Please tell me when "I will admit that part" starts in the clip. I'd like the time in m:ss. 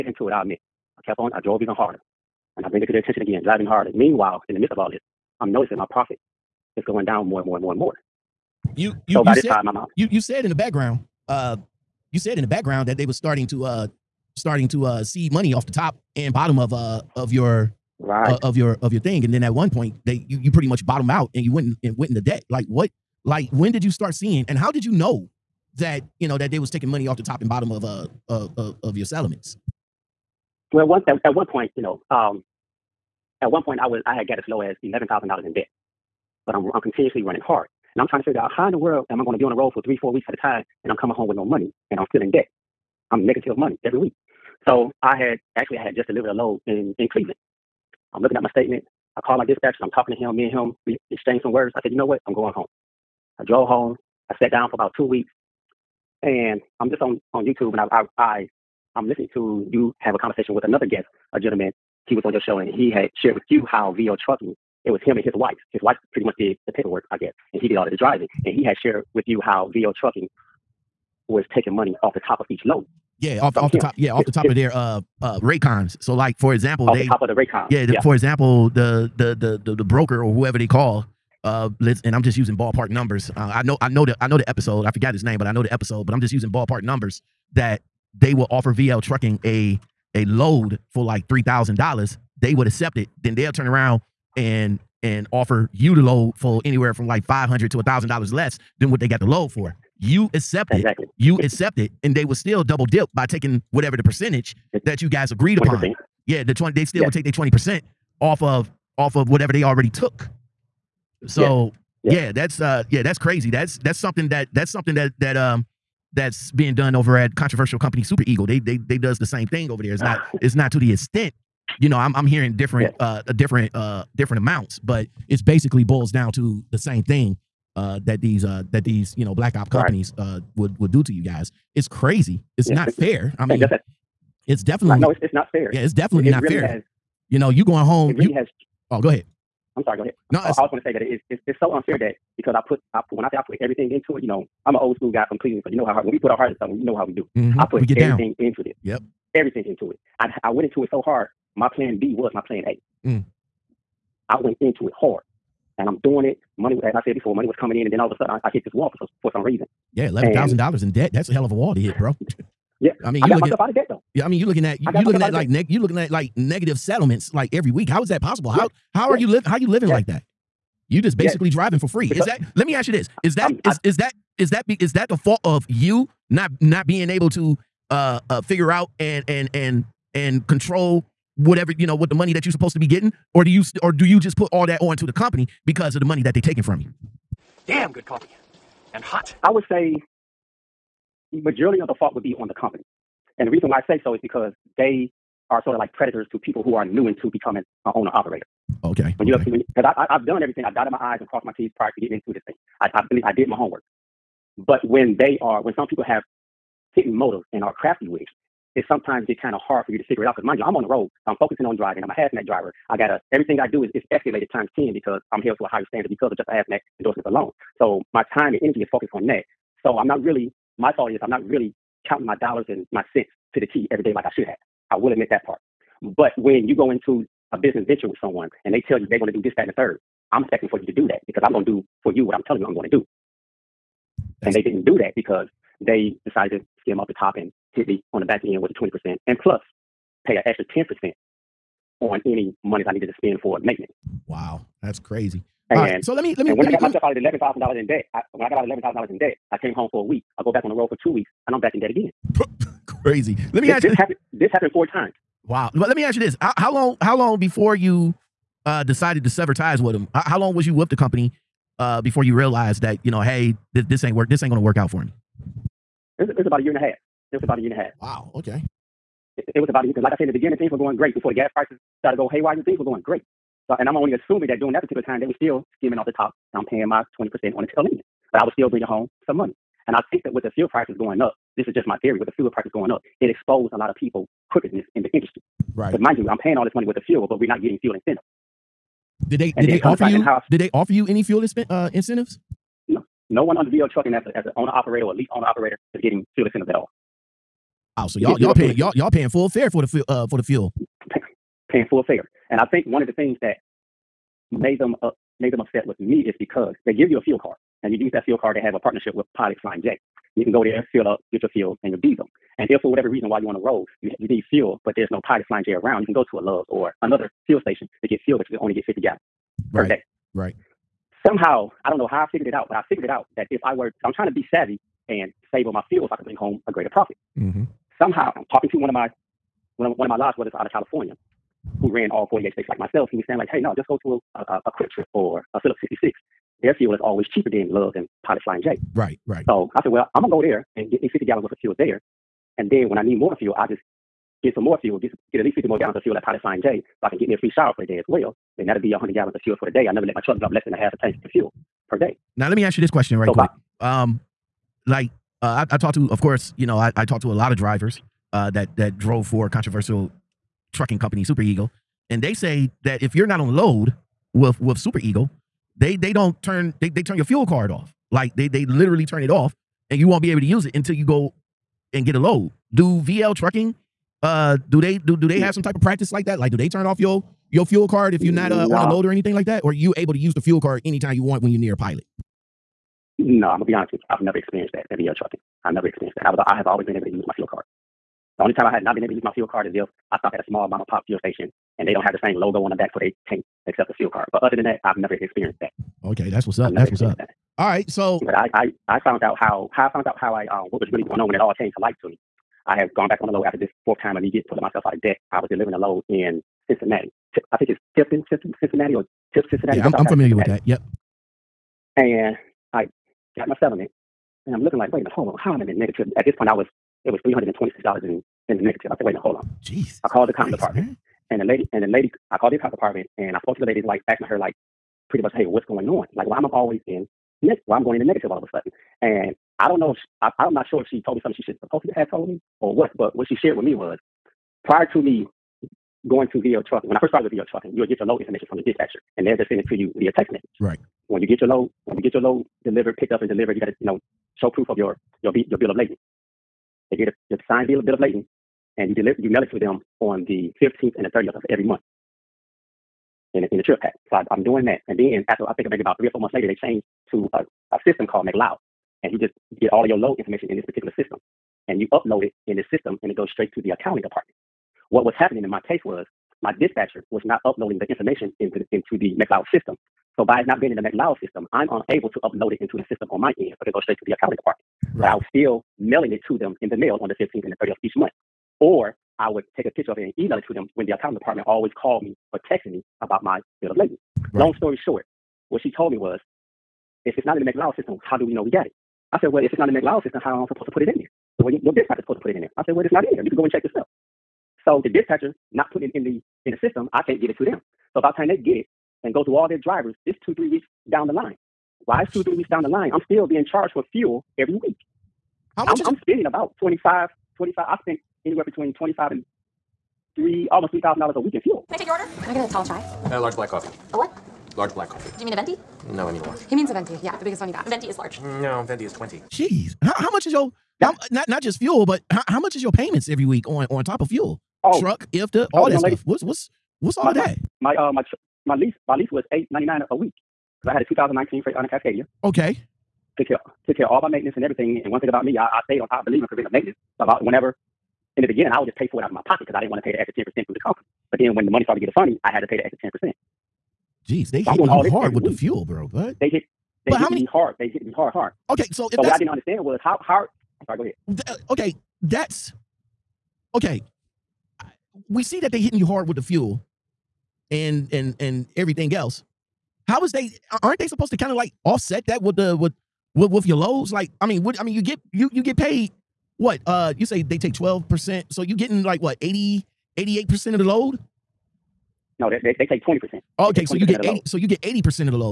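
3:44.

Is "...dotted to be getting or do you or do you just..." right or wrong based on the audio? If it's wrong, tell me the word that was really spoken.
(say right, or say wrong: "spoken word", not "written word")
wrong: "supposed", not "dotted".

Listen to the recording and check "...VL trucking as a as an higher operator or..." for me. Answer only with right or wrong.
wrong.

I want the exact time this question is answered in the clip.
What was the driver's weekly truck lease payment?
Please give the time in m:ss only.
8:49.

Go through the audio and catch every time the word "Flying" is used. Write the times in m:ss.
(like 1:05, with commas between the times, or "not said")
5:09, 5:15, 5:38, 5:46.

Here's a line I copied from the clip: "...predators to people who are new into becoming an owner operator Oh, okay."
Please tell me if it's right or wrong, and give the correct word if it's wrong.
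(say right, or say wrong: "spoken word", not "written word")
right.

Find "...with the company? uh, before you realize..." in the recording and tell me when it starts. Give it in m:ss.
4:20.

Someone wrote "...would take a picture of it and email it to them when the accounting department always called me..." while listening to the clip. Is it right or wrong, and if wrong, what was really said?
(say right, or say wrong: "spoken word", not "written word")
right.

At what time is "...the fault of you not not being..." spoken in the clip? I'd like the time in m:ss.
2:55.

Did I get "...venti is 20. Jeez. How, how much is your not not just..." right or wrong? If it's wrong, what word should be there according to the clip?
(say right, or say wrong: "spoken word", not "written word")
right.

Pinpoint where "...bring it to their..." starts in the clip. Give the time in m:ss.
0:02.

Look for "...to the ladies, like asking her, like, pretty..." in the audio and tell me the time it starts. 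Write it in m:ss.
7:03.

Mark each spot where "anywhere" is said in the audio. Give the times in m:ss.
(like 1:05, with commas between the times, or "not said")
1:36, 8:28.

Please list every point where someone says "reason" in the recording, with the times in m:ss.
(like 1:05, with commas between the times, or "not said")
2:39, 3:13, 5:13.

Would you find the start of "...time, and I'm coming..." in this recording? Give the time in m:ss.
0:40.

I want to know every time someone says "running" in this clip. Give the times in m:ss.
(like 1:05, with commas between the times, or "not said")
0:37.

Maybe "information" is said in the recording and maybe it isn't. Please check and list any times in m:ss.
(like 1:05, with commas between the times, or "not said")
7:18, 7:40, 7:47.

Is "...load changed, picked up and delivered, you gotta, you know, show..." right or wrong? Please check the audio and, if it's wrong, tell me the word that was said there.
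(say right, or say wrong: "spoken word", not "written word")
wrong: "delivered", not "changed".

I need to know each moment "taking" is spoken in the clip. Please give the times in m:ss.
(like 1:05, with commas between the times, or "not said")
0:26, 1:11, 1:43, 3:06.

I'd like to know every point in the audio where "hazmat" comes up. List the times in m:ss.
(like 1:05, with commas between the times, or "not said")
3:32, 3:36.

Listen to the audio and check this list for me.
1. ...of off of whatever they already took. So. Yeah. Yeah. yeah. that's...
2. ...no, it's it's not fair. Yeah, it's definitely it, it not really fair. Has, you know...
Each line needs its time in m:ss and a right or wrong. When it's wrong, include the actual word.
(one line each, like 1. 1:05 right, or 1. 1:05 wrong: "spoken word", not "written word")
1. 1:48 right
2. 2:14 right.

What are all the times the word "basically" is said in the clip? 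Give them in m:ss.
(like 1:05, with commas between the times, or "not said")
2:05, 2:51.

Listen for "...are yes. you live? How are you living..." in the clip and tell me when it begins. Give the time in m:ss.
2:49.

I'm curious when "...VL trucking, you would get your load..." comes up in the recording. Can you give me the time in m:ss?
7:17.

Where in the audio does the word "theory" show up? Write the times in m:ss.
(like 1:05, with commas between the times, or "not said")
4:42.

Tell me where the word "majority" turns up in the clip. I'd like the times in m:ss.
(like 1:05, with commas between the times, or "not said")
3:11.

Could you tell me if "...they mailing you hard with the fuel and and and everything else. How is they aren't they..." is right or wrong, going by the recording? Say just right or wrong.
wrong.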